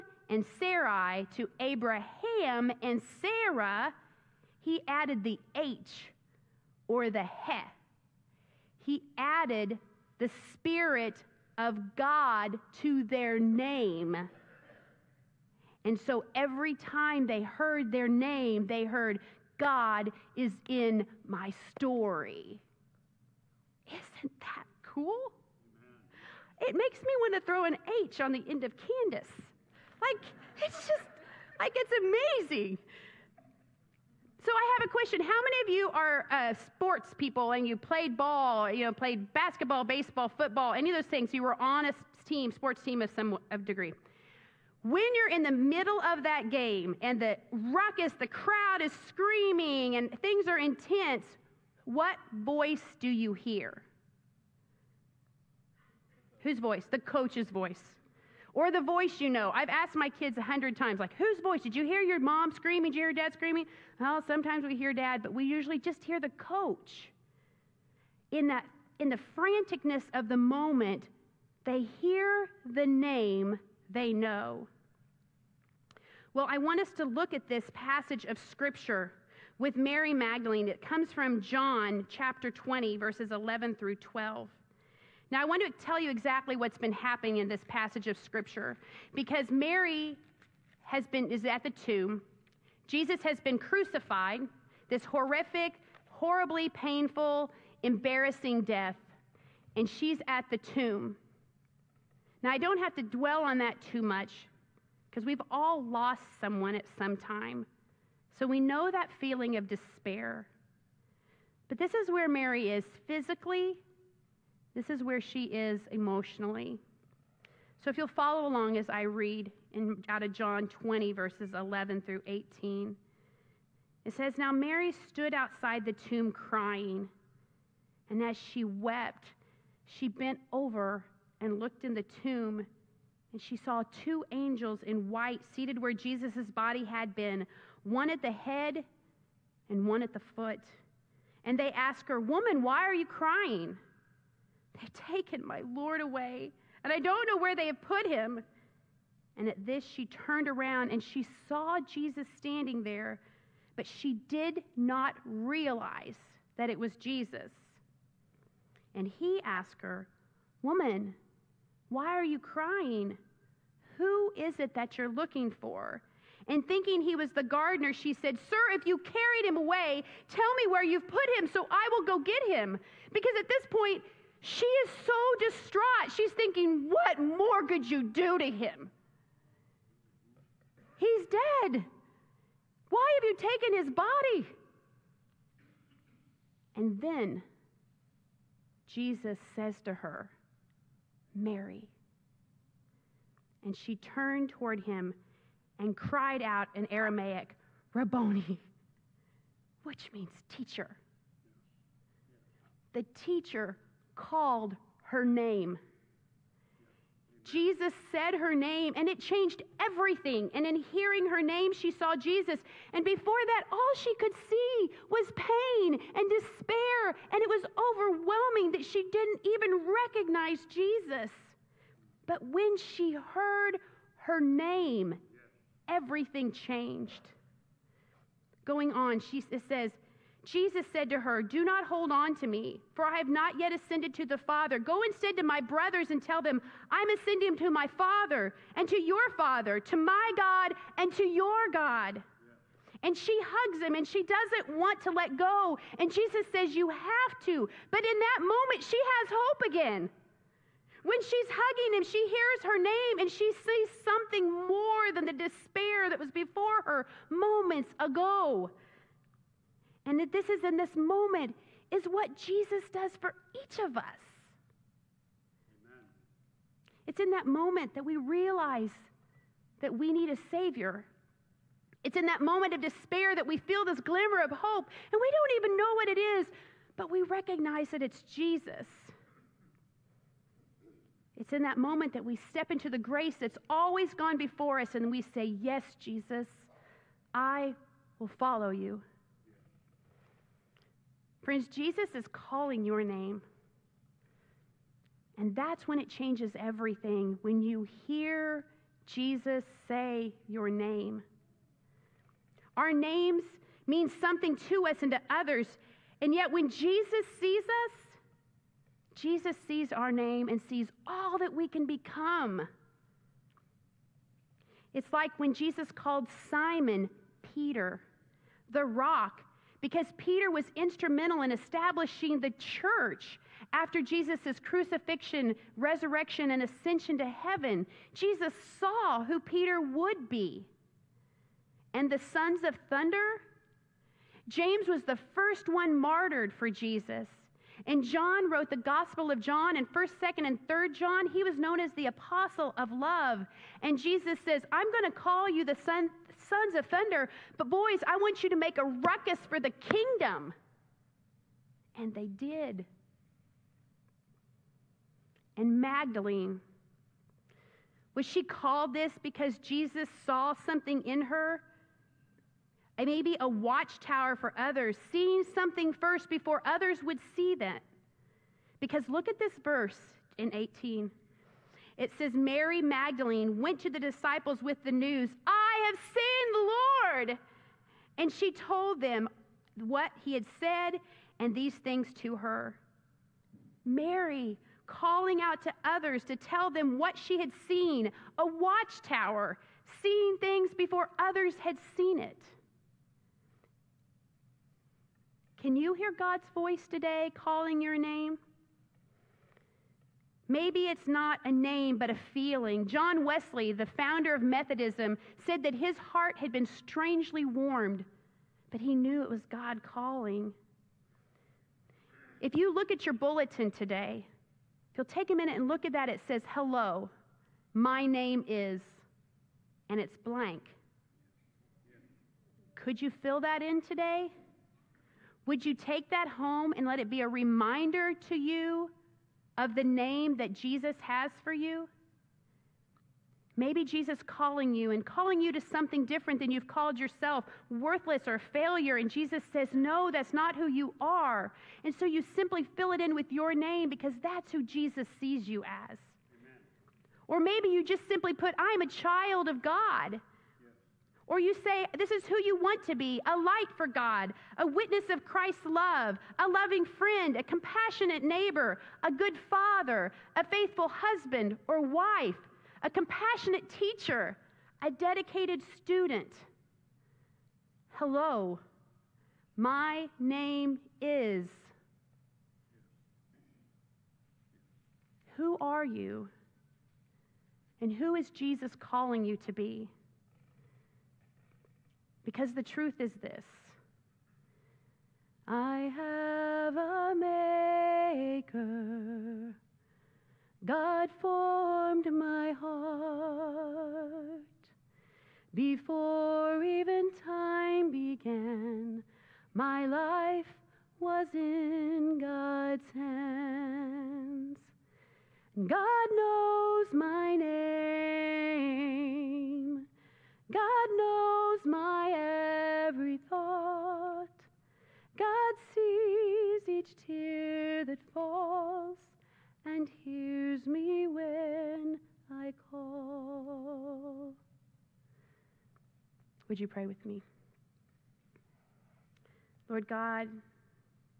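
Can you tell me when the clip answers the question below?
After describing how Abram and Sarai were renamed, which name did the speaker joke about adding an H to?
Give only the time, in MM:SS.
00:28.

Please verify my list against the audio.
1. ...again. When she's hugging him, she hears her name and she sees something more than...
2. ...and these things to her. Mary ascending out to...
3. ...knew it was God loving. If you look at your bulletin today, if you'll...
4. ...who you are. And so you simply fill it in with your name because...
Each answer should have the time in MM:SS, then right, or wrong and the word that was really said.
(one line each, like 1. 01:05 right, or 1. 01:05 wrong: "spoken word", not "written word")
1. 04:09 right
2. 06:21 wrong: "calling", not "ascending"
3. 06:48 wrong: "calling", not "loving"
4. 07:20 right.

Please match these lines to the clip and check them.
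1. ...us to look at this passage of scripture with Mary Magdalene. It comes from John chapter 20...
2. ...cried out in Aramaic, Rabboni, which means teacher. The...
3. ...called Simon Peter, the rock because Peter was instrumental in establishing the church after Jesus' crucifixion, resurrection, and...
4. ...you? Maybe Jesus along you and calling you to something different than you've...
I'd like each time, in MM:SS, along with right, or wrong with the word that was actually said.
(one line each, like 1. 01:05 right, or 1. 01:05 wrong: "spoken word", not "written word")
1. 01:16 right
2. 03:15 right
3. 05:15 right
4. 07:11 wrong: "calling", not "along".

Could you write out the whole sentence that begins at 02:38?
And he asked her, Woman, why are you crying?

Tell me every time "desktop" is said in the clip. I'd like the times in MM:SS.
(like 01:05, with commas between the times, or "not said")
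not said.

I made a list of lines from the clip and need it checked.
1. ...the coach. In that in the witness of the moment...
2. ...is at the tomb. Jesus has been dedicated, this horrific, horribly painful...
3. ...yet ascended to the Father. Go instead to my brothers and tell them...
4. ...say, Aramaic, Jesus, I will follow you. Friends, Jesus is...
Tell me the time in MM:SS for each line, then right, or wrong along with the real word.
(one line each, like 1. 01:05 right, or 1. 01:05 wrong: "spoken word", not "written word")
1. 01:06 wrong: "franticness", not "witness"
2. 01:31 wrong: "crucified", not "dedicated"
3. 03:53 right
4. 04:45 wrong: "Yes", not "Aramaic".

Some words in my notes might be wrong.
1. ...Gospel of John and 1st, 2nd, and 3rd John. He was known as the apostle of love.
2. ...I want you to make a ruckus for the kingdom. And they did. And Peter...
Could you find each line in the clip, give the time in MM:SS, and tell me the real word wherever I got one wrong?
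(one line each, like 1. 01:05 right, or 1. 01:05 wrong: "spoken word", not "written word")
1. 05:38 right
2. 05:48 wrong: "Magdalene", not "Peter".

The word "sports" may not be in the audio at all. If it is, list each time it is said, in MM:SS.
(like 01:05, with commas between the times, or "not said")
00:36, 00:42.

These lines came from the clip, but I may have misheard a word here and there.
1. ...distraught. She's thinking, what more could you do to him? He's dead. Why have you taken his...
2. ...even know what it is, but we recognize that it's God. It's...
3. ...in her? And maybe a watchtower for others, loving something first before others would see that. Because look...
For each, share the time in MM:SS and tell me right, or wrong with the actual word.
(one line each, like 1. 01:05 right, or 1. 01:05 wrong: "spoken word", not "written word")
1. 02:55 right
2. 04:35 wrong: "Jesus", not "God"
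3. 06:01 wrong: "seeing", not "loving".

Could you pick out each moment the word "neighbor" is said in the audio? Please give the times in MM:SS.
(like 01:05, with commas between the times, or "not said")
07:38.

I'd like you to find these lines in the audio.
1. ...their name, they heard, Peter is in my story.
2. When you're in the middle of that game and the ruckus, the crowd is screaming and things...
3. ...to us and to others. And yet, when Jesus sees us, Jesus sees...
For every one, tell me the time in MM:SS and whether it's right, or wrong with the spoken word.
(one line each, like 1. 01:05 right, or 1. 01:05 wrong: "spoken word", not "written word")
1. 00:17 wrong: "God", not "Peter"
2. 00:44 right
3. 05:04 right.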